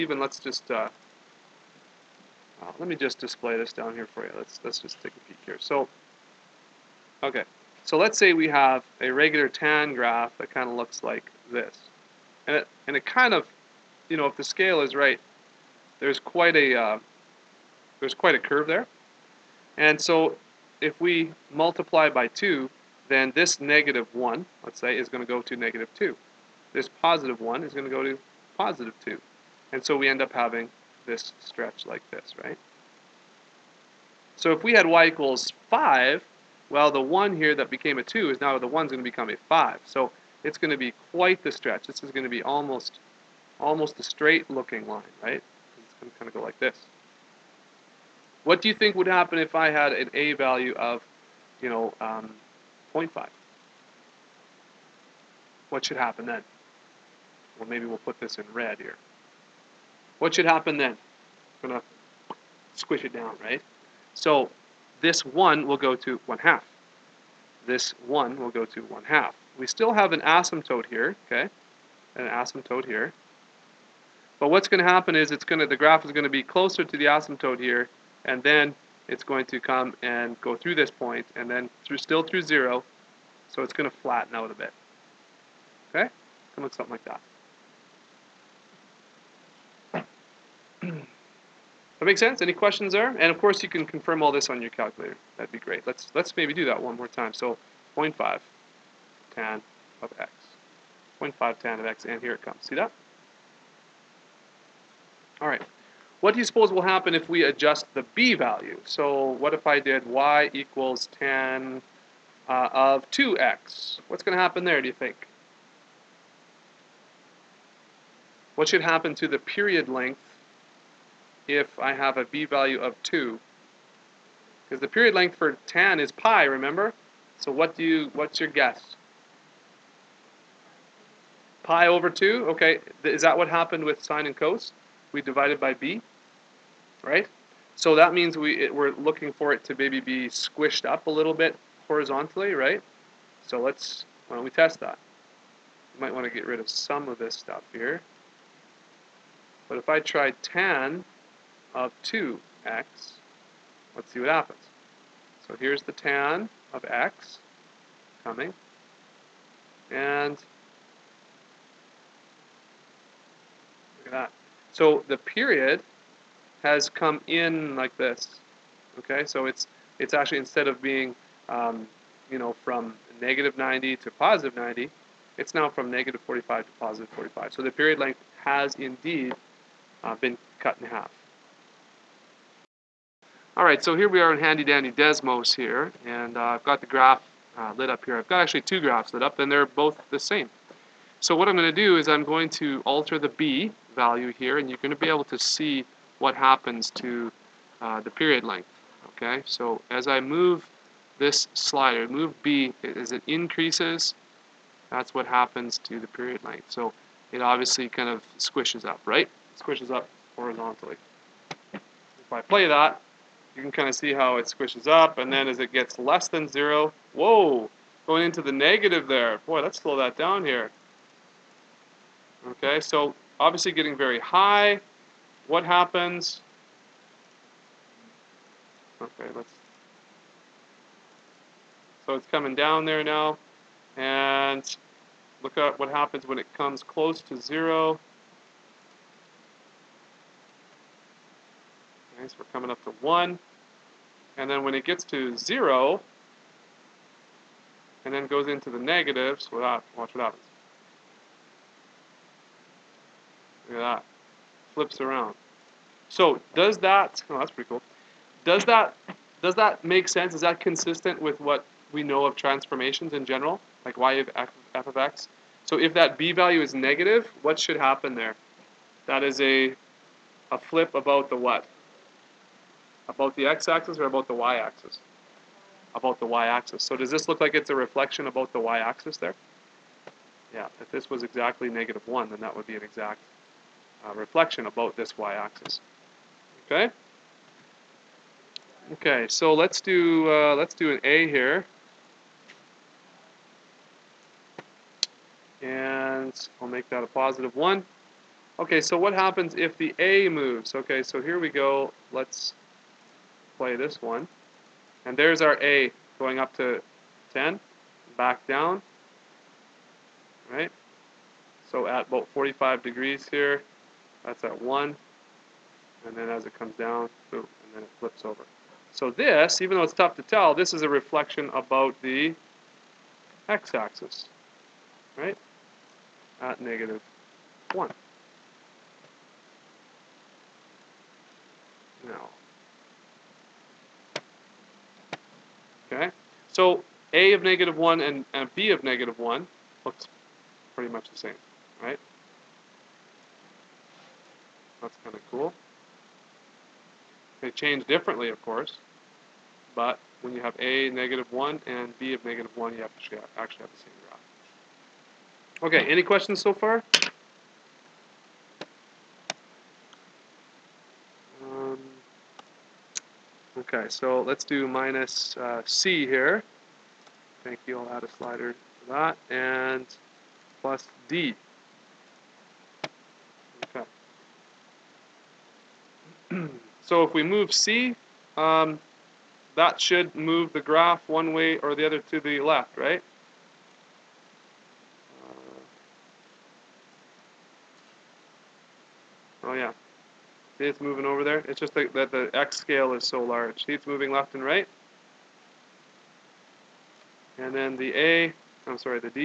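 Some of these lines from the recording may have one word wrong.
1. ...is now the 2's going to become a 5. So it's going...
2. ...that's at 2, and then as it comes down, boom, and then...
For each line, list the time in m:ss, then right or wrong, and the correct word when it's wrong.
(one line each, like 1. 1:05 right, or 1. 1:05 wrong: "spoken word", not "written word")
1. 0:38 wrong: "1", not "2"
2. 5:14 wrong: "1", not "2".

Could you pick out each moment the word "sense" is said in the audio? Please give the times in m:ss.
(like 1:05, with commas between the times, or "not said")
1:32, 4:20.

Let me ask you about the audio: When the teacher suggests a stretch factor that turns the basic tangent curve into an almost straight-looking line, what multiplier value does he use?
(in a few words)
5.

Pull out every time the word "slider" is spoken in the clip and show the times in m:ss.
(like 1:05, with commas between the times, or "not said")
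3:21, 6:08.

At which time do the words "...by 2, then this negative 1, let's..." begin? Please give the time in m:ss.
0:22.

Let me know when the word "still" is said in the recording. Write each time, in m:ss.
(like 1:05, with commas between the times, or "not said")
1:09, 1:21.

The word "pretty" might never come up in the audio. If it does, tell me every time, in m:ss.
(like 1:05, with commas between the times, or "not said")
4:17, 5:40.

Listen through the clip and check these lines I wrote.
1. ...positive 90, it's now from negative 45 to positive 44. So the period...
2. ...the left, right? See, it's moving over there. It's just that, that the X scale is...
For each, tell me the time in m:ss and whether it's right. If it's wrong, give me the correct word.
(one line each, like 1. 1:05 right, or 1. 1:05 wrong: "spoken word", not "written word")
1. 2:54 wrong: "45", not "44"
2. 6:22 right.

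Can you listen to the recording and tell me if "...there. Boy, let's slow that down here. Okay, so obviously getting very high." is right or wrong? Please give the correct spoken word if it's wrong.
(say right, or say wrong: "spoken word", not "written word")
right.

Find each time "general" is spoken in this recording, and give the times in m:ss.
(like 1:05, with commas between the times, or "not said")
4:23.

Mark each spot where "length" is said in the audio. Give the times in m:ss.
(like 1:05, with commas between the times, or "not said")
1:59, 2:05, 2:57, 3:18, 3:26.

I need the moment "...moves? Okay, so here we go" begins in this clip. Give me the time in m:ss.
5:00.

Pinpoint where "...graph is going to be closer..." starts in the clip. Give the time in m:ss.
1:15.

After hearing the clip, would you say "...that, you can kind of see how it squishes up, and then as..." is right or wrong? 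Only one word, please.
right.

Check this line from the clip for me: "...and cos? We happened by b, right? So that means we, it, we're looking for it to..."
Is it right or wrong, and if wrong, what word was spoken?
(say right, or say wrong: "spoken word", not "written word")
wrong: "divided", not "happened".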